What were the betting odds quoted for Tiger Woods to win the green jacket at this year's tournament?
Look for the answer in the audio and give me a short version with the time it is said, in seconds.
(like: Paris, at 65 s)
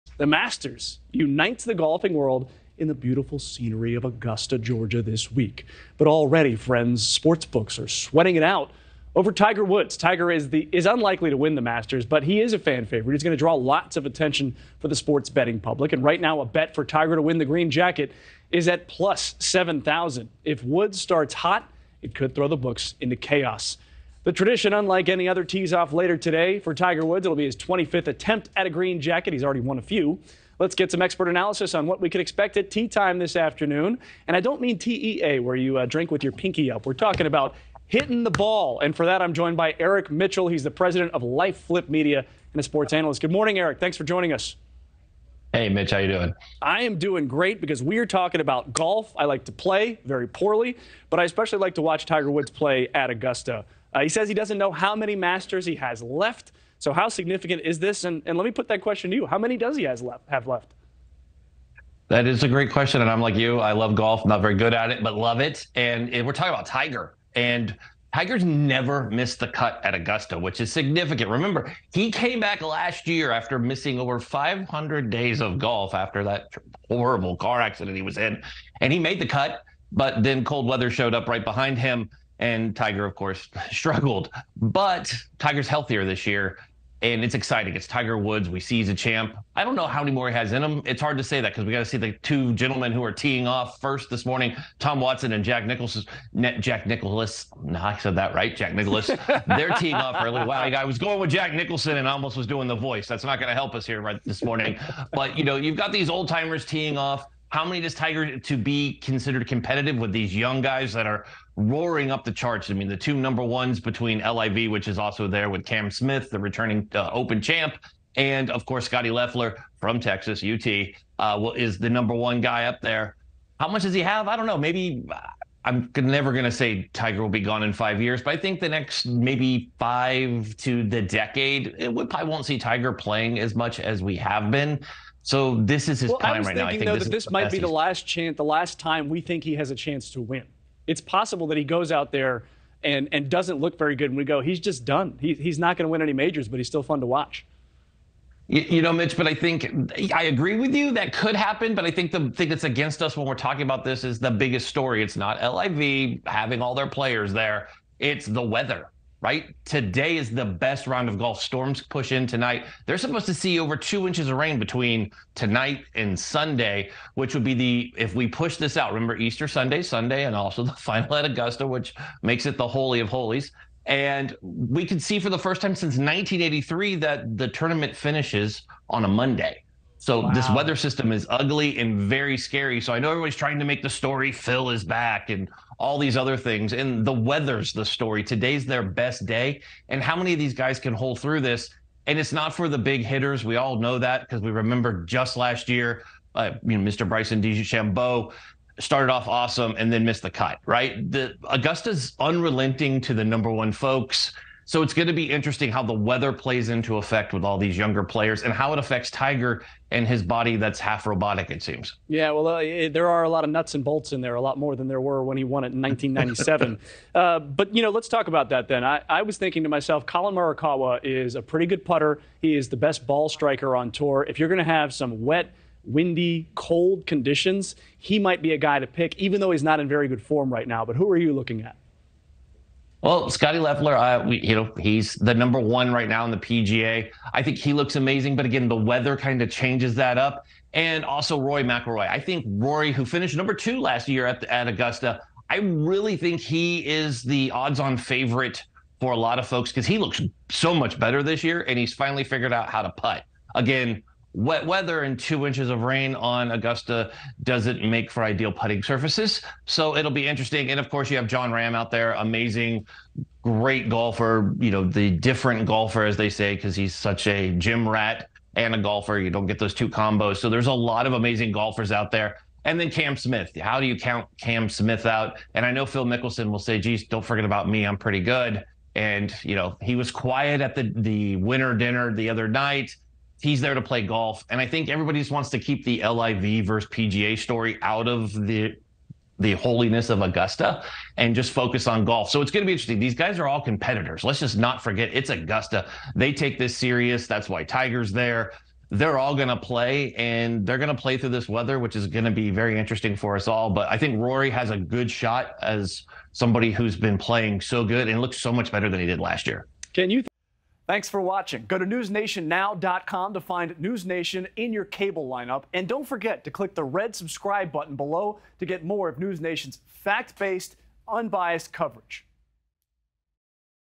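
+7000, at 18 s.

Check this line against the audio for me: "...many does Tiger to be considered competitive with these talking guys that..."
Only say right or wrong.
wrong.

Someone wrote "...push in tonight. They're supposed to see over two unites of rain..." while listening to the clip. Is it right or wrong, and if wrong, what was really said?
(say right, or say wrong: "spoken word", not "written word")
wrong: "inches", not "unites".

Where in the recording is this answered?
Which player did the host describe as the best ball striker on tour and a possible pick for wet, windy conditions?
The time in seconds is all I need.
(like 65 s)
220 s.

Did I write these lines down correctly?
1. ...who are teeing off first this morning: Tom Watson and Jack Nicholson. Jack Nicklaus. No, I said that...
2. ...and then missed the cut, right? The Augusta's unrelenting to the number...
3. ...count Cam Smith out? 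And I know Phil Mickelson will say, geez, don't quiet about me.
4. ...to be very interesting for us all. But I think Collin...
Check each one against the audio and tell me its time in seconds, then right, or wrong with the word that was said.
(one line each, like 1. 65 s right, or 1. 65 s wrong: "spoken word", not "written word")
1. 92 s right
2. 199 s right
3. 273 s wrong: "forget", not "quiet"
4. 302 s wrong: "Rory", not "Collin".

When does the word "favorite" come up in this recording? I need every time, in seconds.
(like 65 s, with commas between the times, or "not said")
12 s, 247 s.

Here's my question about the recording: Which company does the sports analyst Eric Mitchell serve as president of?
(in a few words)
Life Flip Media.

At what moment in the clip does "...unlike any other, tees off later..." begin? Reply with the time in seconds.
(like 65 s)
24 s.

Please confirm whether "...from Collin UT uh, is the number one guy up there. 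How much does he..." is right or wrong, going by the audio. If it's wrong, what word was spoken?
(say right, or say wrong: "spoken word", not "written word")
wrong: "Texas", not "Collin".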